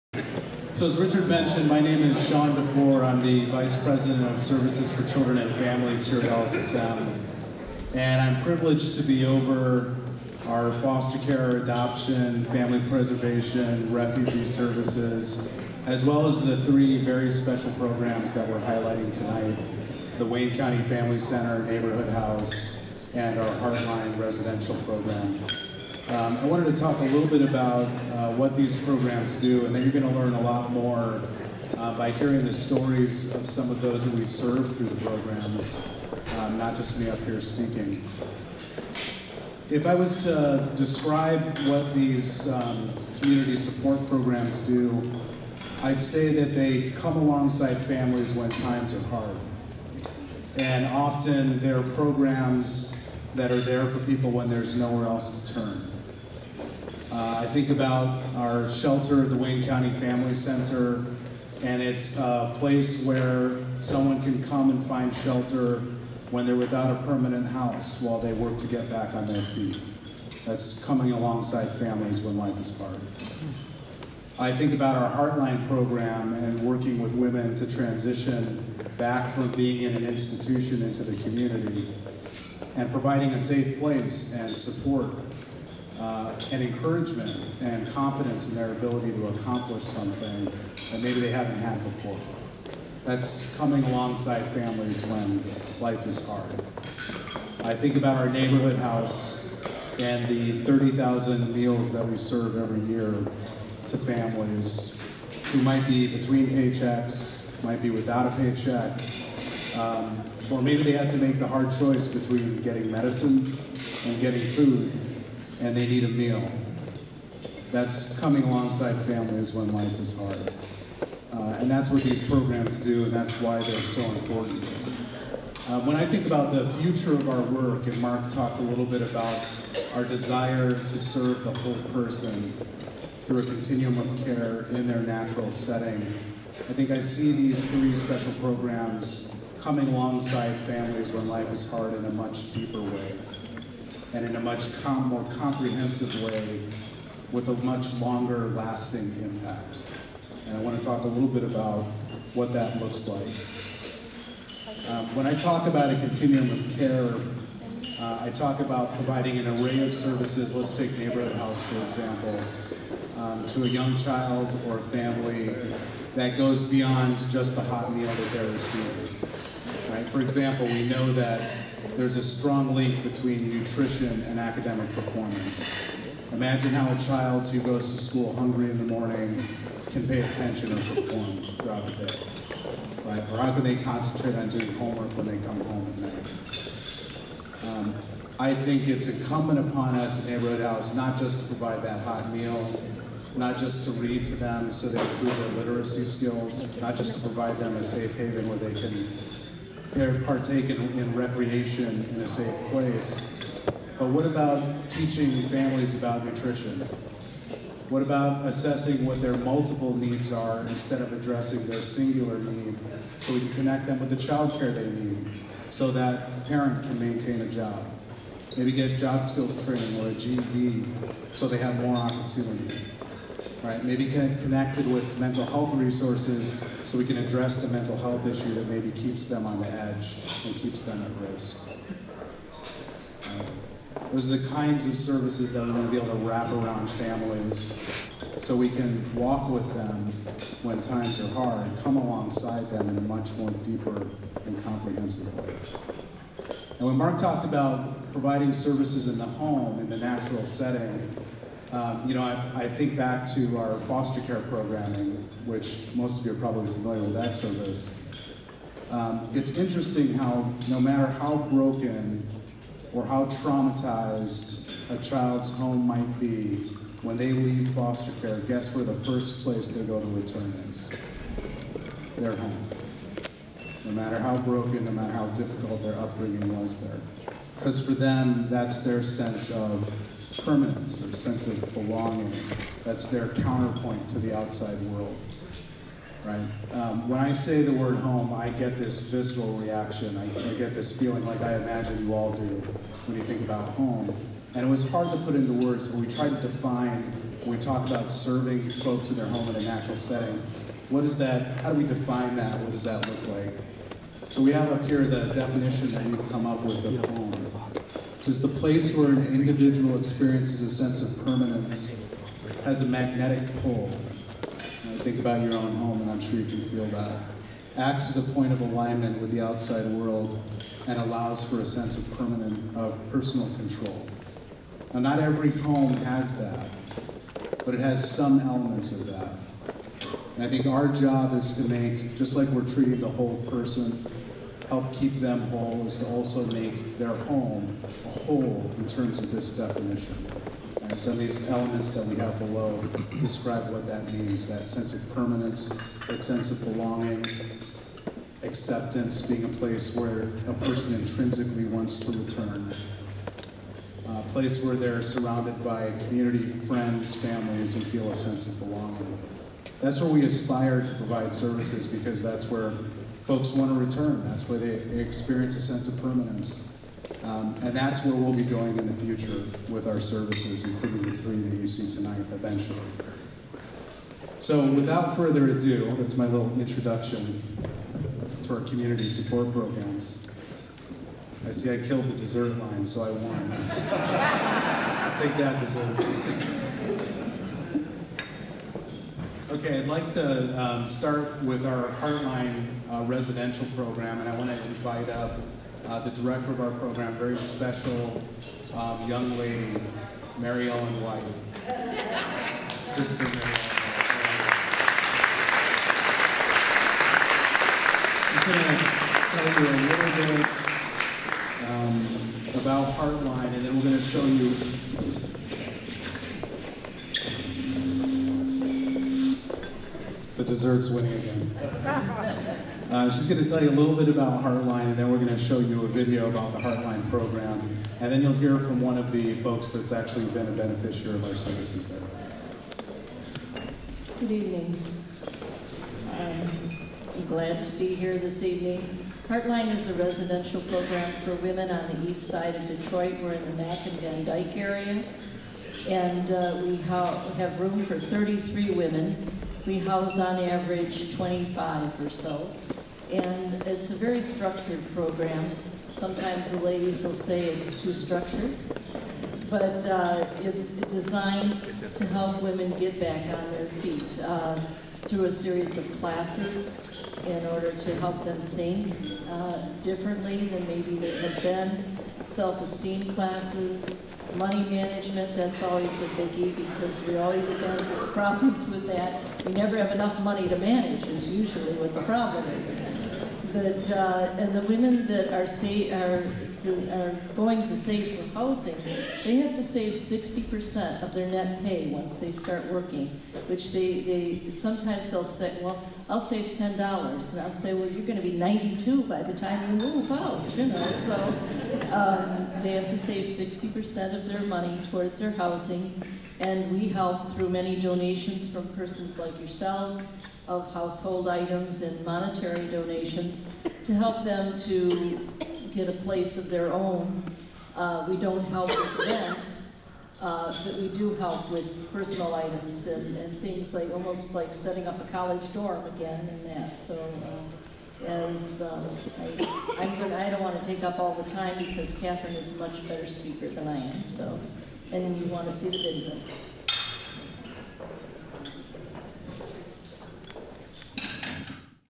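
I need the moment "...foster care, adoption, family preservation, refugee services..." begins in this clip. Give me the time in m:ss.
0:10.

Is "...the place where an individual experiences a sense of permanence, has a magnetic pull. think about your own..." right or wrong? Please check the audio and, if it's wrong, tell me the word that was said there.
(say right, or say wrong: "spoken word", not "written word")
right.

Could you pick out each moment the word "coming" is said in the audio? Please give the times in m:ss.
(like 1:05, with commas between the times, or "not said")
1:10, 1:33, 1:58, 2:19.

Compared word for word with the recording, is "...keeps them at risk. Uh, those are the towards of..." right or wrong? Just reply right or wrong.
wrong.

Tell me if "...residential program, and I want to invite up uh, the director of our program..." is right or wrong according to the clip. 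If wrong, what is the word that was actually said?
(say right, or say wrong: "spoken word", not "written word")
right.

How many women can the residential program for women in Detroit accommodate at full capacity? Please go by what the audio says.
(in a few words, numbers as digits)
33.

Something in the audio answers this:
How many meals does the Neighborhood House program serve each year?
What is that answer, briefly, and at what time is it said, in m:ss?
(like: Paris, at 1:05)
30,000, at 1:40.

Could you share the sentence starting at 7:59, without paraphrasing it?
We never have enough money to manage is usually what the problem is.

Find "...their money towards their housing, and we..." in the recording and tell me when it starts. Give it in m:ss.
8:24.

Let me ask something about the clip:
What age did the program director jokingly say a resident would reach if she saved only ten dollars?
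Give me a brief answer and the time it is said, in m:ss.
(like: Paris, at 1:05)
92, at 8:18.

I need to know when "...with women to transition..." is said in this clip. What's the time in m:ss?
1:16.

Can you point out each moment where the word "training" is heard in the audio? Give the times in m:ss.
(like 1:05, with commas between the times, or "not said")
3:39.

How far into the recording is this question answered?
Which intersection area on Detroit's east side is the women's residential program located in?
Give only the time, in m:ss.
7:23.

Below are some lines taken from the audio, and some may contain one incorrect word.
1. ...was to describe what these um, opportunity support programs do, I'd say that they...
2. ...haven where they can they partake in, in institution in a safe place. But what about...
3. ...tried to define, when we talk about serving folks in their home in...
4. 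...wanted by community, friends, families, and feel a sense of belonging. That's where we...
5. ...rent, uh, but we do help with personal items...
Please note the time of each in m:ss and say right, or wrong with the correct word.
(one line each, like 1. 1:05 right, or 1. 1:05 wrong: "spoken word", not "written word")
1. 0:39 wrong: "community", not "opportunity"
2. 3:18 wrong: "recreation", not "institution"
3. 4:56 right
4. 5:55 wrong: "surrounded", not "wanted"
5. 8:39 right.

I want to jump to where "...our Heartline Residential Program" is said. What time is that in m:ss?
0:23.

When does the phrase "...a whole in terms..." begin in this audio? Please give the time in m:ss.
5:38.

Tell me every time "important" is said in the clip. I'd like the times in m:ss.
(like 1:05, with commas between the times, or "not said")
2:04.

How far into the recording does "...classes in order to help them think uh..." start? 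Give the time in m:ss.
7:45.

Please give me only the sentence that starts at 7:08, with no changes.
And then you'll hear from one of the folks that's actually been a beneficiary of our services there.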